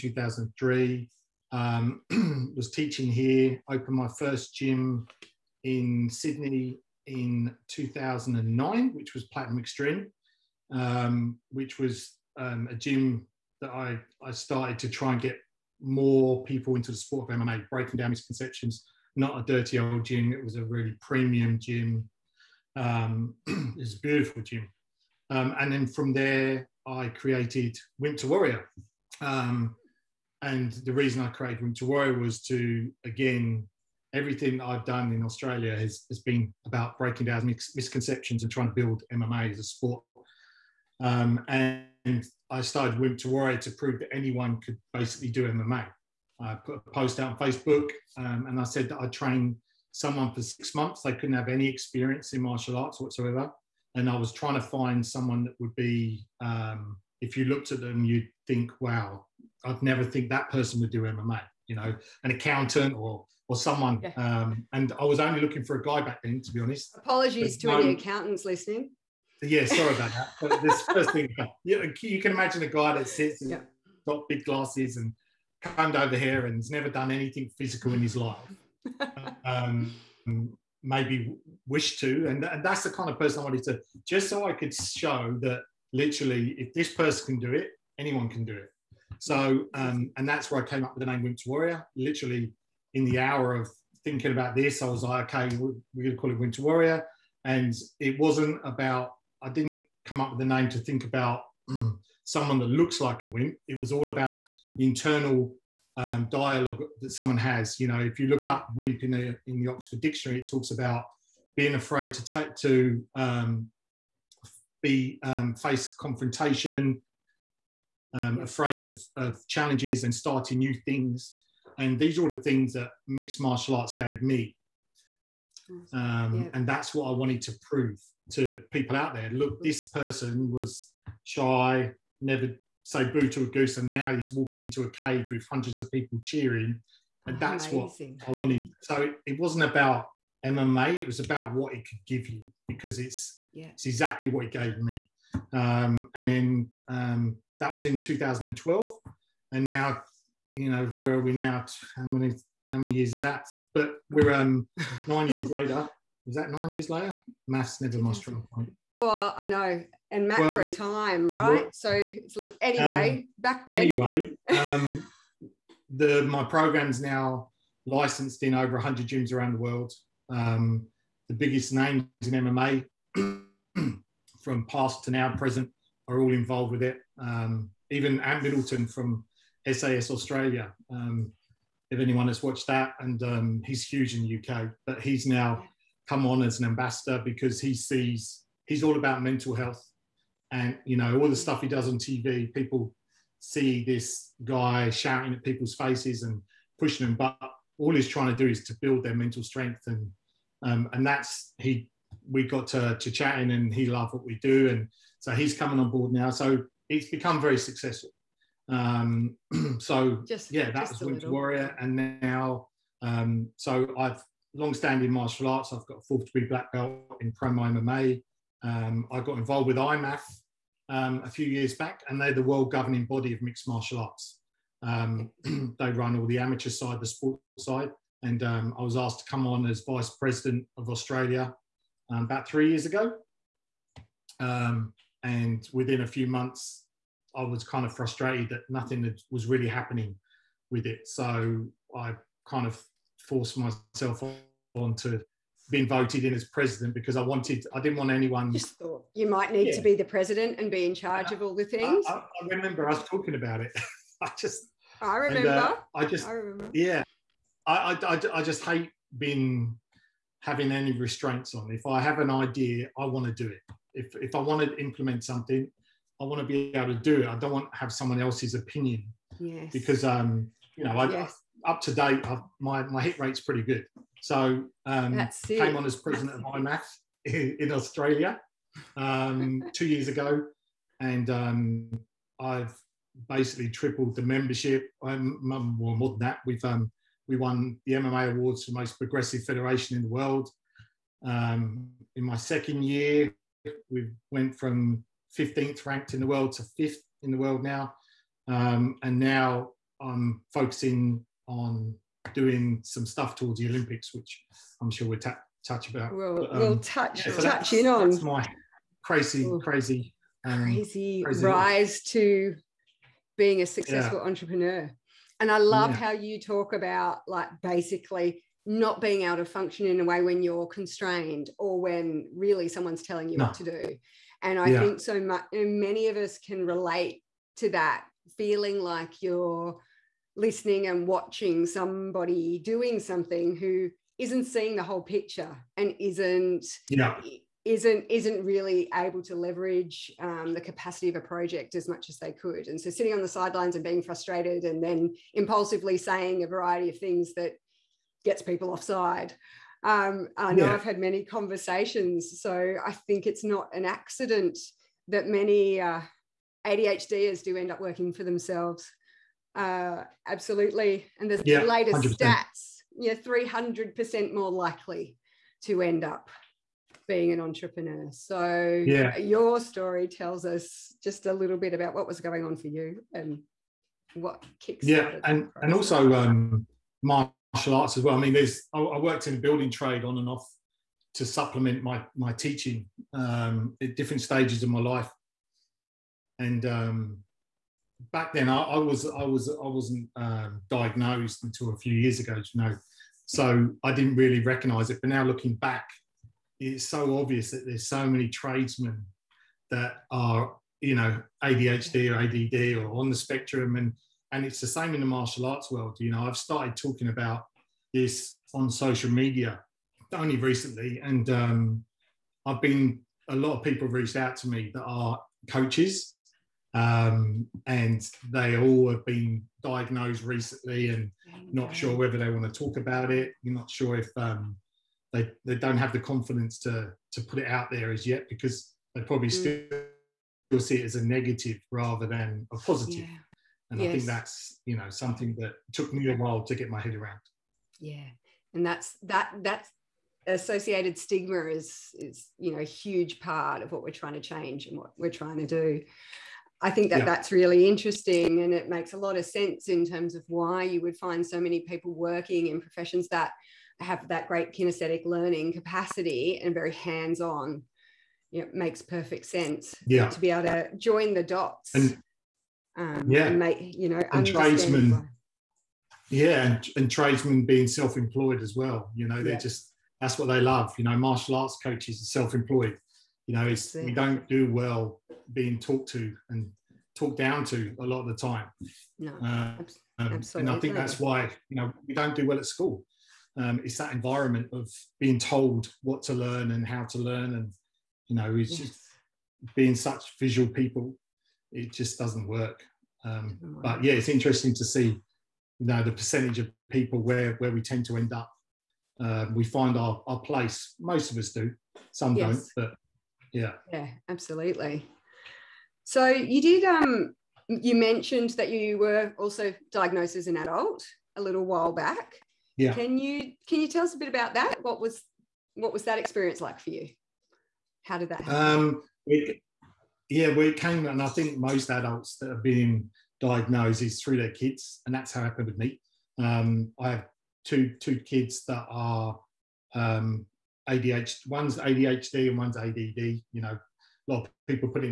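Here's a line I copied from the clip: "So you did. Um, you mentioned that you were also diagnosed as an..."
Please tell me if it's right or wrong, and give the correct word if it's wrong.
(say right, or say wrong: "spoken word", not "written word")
right.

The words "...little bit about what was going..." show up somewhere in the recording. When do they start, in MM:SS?
06:11.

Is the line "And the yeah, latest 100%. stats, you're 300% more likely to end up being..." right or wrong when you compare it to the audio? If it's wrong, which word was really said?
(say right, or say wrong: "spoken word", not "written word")
right.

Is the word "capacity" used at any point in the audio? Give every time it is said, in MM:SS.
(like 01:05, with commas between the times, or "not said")
05:40, 07:35.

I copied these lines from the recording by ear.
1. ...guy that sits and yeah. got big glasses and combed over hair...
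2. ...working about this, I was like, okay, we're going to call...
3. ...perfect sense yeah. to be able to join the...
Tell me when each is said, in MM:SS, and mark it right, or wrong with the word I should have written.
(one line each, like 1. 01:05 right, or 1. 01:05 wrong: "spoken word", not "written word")
1. 01:12 right
2. 01:34 wrong: "thinking", not "working"
3. 07:38 right.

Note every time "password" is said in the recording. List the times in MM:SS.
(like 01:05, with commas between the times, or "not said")
not said.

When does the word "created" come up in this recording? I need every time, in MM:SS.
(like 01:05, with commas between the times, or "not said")
00:27, 00:31.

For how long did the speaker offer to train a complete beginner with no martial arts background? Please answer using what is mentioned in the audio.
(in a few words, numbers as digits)
six months.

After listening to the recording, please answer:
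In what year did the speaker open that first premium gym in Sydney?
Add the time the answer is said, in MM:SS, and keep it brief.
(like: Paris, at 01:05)
2009, at 00:07.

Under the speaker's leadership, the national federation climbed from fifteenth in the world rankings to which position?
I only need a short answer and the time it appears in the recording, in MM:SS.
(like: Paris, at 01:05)
5th, at 04:56.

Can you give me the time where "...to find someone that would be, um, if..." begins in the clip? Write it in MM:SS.
00:54.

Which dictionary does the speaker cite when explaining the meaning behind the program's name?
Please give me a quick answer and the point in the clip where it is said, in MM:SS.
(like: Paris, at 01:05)
Oxford Dictionary, at 01:49.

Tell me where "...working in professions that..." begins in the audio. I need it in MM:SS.
07:31.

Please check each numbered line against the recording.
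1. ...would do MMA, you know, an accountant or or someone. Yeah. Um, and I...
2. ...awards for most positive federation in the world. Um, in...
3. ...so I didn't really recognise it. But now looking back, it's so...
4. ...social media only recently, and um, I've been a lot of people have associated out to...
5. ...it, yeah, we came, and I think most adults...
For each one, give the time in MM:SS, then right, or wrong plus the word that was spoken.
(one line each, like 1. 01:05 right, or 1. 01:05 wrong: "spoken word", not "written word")
1. 01:00 right
2. 04:48 wrong: "progressive", not "positive"
3. 06:33 right
4. 06:48 wrong: "reached", not "associated"
5. 08:39 right.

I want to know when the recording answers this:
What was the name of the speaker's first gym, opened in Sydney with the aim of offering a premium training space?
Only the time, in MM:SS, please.
00:09.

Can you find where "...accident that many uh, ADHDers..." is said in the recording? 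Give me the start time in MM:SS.
05:53.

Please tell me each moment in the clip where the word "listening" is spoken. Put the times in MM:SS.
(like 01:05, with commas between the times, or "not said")
01:08, 05:30.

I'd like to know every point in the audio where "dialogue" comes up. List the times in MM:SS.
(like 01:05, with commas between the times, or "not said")
01:46.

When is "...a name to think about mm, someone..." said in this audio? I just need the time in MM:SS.
01:40.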